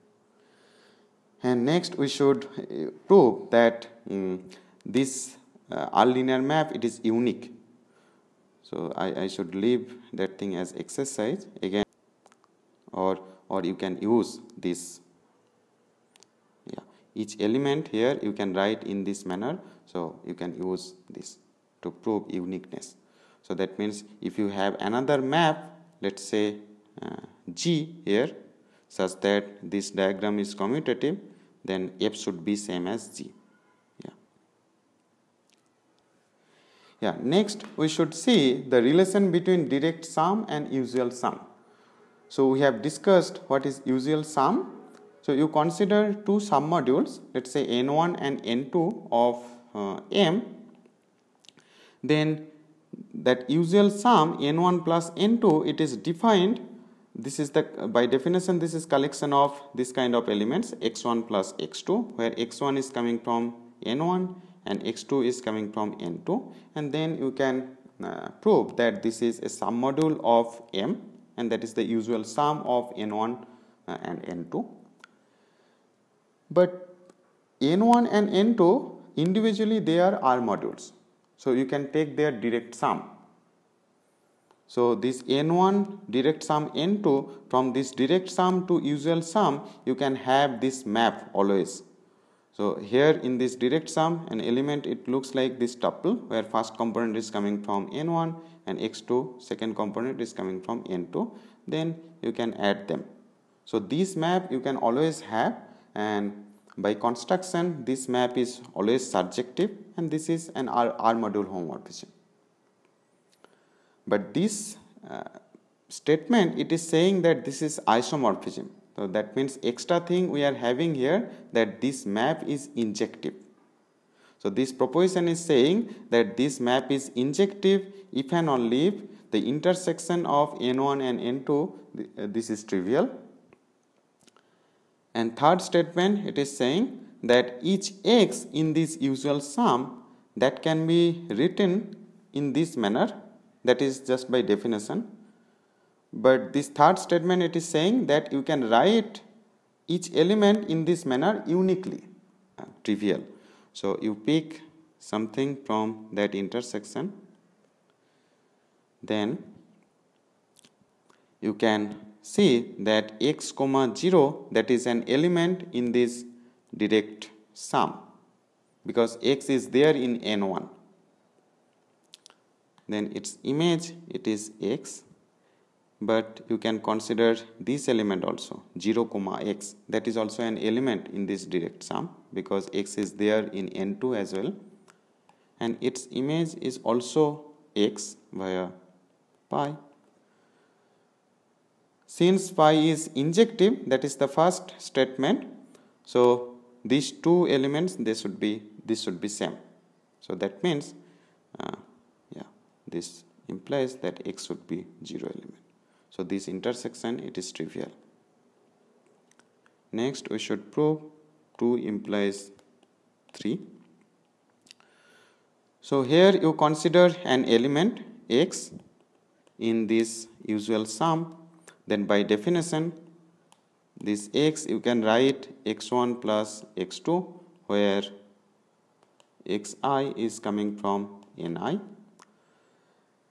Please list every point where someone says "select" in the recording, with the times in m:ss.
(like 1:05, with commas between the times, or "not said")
not said.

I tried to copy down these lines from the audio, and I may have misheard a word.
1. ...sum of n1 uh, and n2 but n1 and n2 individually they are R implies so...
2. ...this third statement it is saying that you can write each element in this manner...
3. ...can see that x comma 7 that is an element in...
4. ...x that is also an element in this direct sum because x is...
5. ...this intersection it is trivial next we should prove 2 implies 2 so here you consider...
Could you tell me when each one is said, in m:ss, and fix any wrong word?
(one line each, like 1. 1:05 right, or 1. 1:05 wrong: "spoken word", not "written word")
1. 1:12 wrong: "modules", not "implies"
2. 2:26 right
3. 2:41 wrong: "0", not "7"
4. 2:59 right
5. 3:26 wrong: "3", not "2".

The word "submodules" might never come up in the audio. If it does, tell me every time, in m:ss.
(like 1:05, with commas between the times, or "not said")
0:46, 1:09.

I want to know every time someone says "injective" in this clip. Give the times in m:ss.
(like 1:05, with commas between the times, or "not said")
2:02, 2:07, 3:13.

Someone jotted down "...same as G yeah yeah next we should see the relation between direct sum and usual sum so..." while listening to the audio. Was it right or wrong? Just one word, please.
right.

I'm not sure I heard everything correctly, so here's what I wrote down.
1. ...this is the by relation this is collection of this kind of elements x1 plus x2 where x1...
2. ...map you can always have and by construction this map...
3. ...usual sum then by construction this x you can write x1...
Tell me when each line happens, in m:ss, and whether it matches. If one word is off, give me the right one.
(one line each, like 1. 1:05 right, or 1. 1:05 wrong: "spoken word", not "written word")
1. 0:57 wrong: "definition", not "relation"
2. 1:44 right
3. 3:40 wrong: "definition", not "construction".